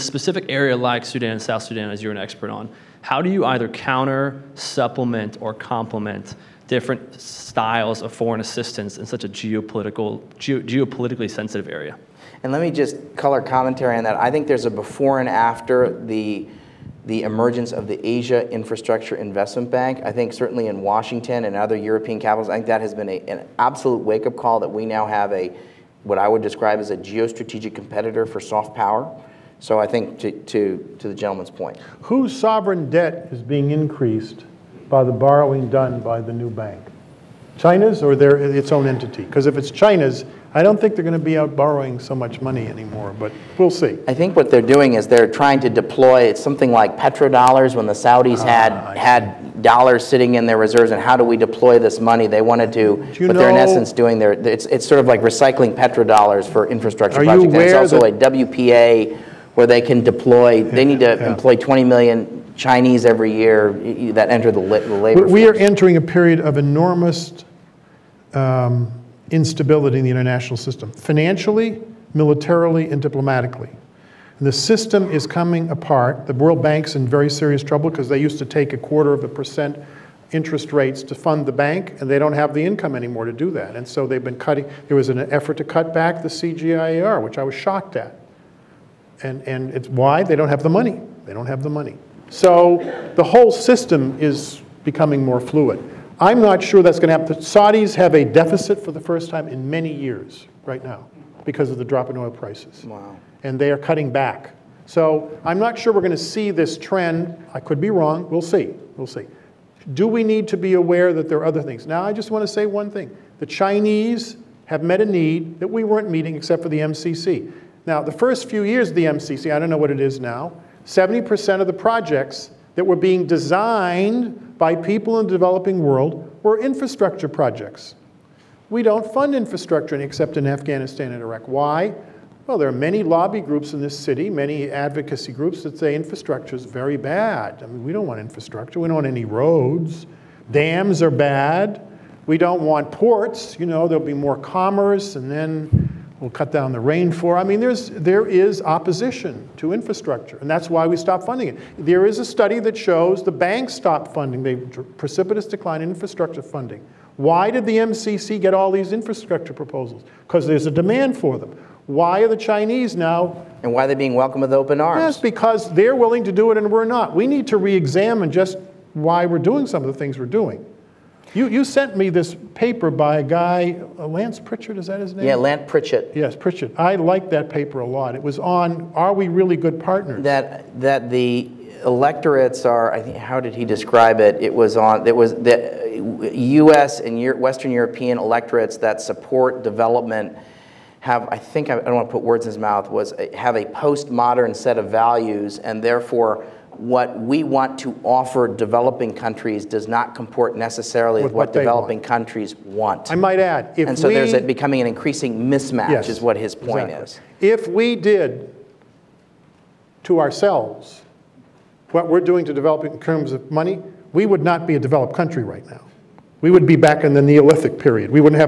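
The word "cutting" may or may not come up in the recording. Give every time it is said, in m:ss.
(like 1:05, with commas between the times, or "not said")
1:24, 1:43.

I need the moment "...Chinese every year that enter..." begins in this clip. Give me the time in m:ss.
1:02.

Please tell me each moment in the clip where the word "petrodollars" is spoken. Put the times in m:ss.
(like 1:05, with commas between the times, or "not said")
0:46, 0:55.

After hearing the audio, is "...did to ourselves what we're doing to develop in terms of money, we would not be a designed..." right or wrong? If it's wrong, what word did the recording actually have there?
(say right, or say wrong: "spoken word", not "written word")
wrong: "developed", not "designed".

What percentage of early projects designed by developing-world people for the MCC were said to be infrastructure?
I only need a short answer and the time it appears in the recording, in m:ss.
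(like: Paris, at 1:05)
70%, at 2:00.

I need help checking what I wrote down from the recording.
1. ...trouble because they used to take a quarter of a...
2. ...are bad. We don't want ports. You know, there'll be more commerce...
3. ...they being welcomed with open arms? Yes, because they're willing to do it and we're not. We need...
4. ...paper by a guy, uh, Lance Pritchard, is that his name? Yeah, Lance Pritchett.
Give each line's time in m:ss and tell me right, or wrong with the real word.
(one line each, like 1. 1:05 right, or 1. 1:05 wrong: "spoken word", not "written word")
1. 1:17 right
2. 2:21 right
3. 2:43 right
4. 2:52 right.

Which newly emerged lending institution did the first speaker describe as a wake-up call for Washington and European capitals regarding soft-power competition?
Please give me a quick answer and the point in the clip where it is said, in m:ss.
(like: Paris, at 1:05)
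Asia Infrastructure Investment Bank, at 0:18.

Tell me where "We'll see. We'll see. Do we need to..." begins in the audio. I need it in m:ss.
1:48.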